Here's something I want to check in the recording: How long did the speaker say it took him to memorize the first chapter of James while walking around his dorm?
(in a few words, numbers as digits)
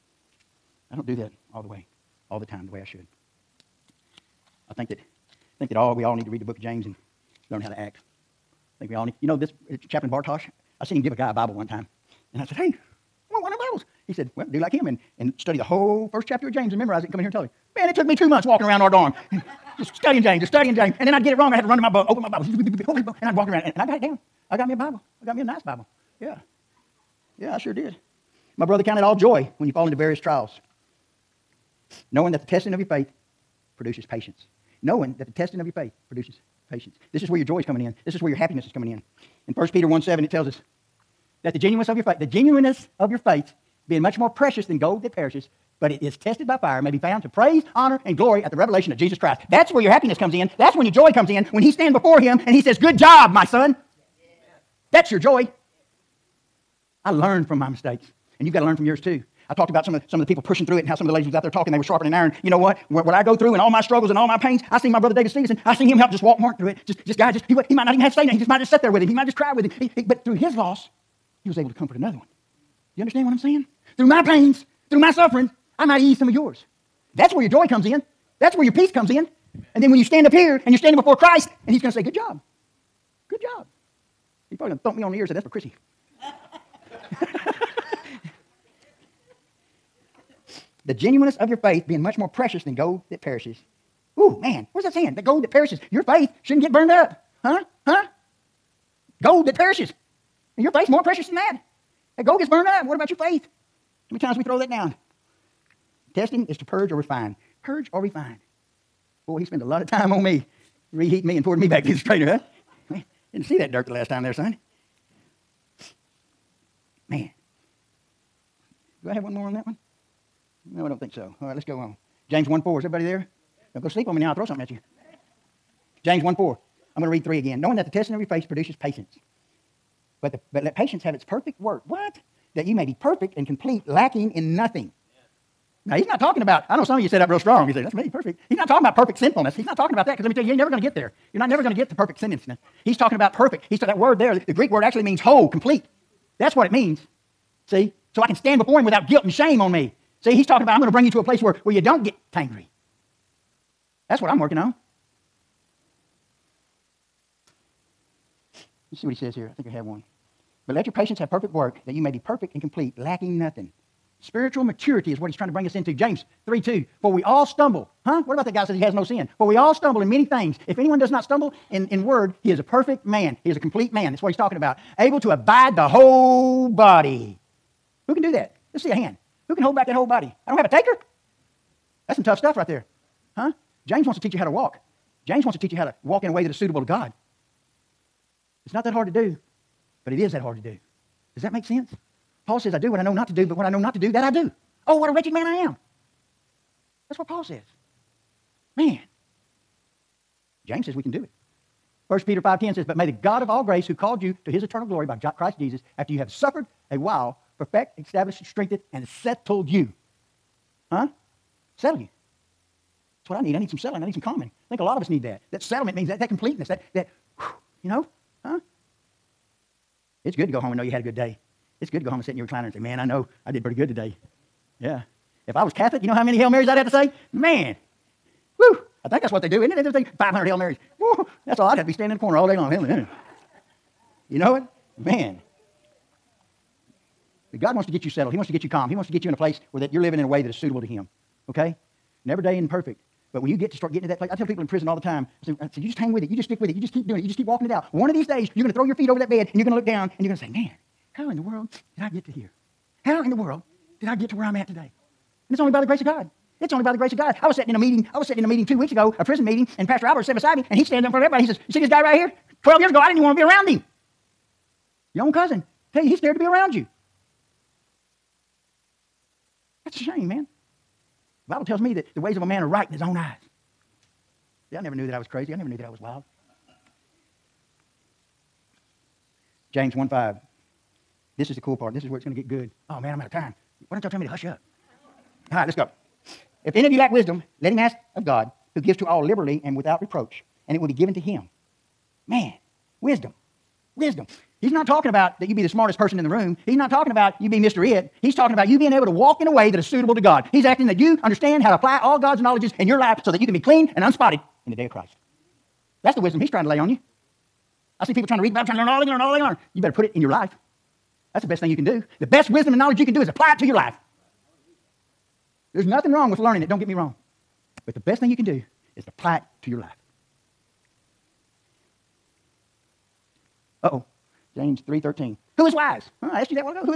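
two months.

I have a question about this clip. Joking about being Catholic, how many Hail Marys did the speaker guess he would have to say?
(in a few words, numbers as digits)
500.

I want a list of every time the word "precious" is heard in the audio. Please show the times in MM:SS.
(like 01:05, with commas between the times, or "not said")
00:44, 01:32, 01:41.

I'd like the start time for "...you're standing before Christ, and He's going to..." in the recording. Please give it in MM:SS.
01:20.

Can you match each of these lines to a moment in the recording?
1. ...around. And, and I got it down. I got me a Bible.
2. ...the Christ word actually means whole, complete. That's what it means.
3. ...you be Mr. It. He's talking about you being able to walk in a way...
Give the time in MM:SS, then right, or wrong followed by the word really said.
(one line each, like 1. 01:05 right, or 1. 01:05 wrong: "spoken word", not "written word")
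1. 00:23 right
2. 02:24 wrong: "Greek", not "Christ"
3. 04:57 right.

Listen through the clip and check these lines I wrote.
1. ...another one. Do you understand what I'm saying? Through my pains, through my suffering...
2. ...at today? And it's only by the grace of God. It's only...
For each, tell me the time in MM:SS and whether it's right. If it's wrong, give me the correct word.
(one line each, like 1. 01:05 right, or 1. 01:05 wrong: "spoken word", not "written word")
1. 01:11 right
2. 04:14 right.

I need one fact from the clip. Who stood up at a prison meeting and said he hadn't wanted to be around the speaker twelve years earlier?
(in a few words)
Pastor Albert.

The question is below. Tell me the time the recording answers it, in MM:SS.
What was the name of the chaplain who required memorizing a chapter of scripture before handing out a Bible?
00:09.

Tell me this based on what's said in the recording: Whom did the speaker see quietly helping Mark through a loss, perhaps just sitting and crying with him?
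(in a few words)
David Stevenson.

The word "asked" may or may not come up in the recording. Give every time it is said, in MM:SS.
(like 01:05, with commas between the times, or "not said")
05:26.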